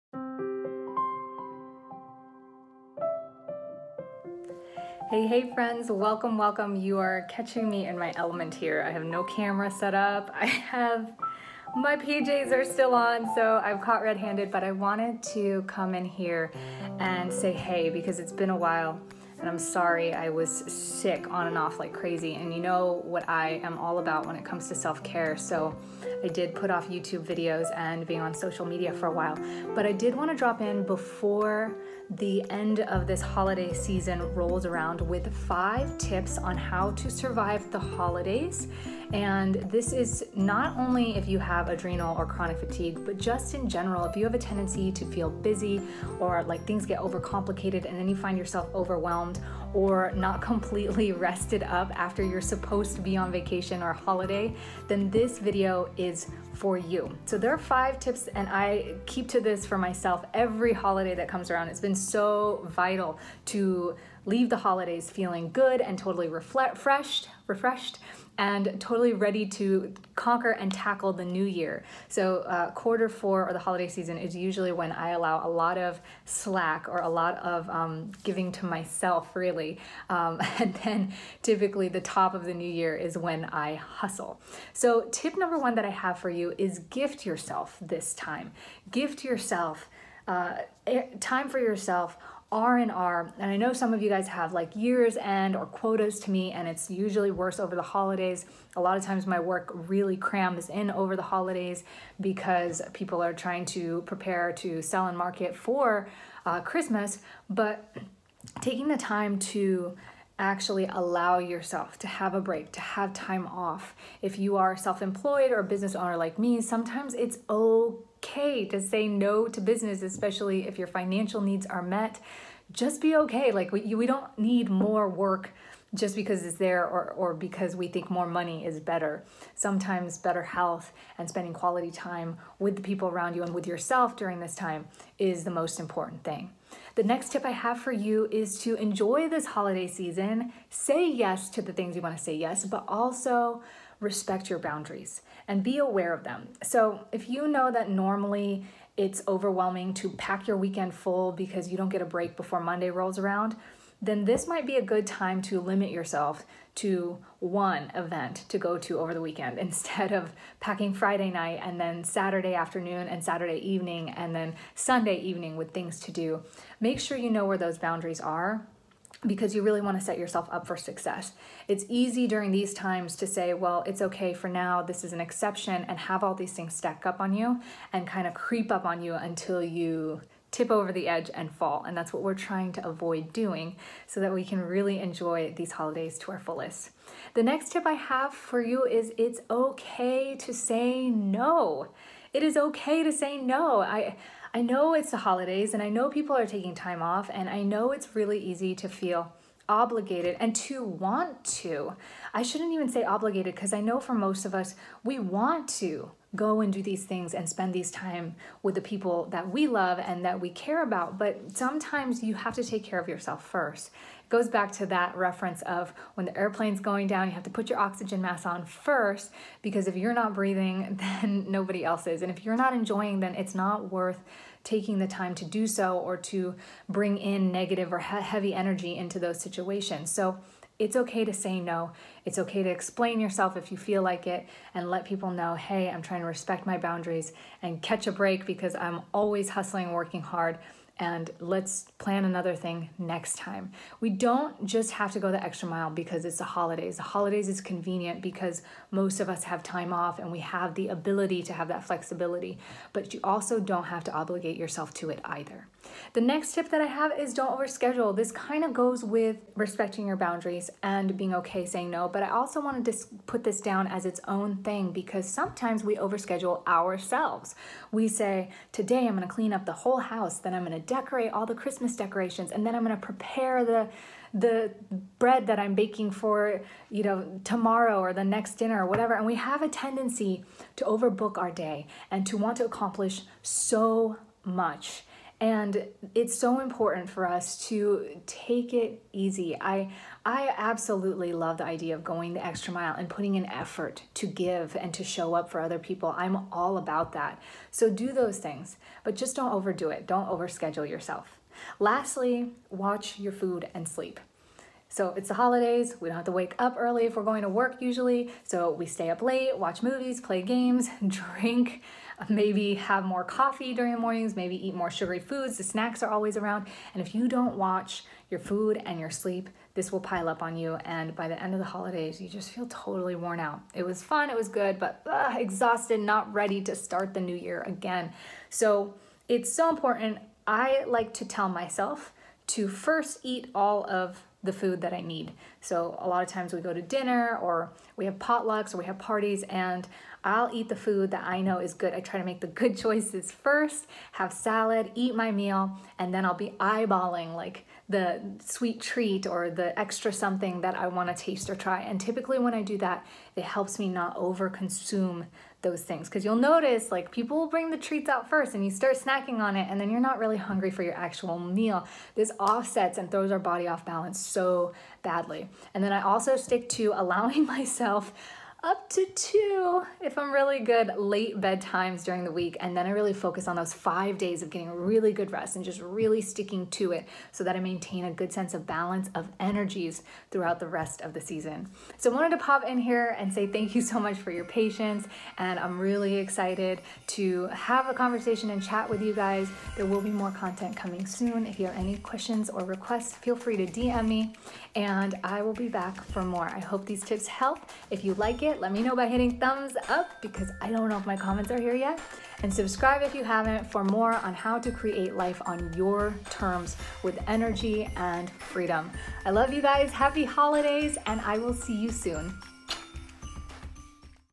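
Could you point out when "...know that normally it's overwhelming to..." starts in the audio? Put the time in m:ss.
2:27.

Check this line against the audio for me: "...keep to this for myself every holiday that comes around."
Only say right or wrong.
right.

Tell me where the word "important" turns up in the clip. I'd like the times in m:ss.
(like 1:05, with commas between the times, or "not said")
2:15, 4:46, 5:29.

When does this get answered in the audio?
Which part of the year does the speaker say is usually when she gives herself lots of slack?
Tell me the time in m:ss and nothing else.
1:12.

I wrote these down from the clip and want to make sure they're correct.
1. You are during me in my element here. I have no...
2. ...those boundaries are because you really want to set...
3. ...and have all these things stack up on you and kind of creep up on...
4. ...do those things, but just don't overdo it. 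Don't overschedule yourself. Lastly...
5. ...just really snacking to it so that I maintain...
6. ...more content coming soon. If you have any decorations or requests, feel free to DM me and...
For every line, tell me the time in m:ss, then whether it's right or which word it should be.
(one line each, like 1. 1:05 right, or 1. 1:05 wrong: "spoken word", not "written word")
1. 0:06 wrong: "catching", not "during"
2. 2:47 right
3. 2:55 right
4. 4:57 right
5. 6:15 wrong: "sticking", not "snacking"
6. 6:30 wrong: "questions", not "decorations".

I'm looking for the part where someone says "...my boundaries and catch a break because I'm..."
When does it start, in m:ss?
3:56.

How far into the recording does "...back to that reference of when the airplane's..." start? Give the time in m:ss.
3:34.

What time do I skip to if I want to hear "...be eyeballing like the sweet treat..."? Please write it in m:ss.
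5:46.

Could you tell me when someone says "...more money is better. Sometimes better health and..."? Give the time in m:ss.
2:08.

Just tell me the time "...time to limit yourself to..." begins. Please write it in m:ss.
2:35.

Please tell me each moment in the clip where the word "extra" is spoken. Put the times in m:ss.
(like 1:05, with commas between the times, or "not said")
4:05, 4:52, 5:49.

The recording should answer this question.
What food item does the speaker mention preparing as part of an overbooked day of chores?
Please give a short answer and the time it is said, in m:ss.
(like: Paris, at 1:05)
Bread, at 4:35.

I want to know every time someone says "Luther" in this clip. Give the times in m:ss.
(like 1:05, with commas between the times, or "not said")
not said.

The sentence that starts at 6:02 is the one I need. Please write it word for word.
This offsets and throws our body off balance so badly.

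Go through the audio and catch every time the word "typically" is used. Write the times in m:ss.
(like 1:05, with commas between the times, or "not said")
1:21, 5:51.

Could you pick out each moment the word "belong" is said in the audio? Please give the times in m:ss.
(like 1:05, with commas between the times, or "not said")
not said.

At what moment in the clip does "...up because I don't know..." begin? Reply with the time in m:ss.
6:39.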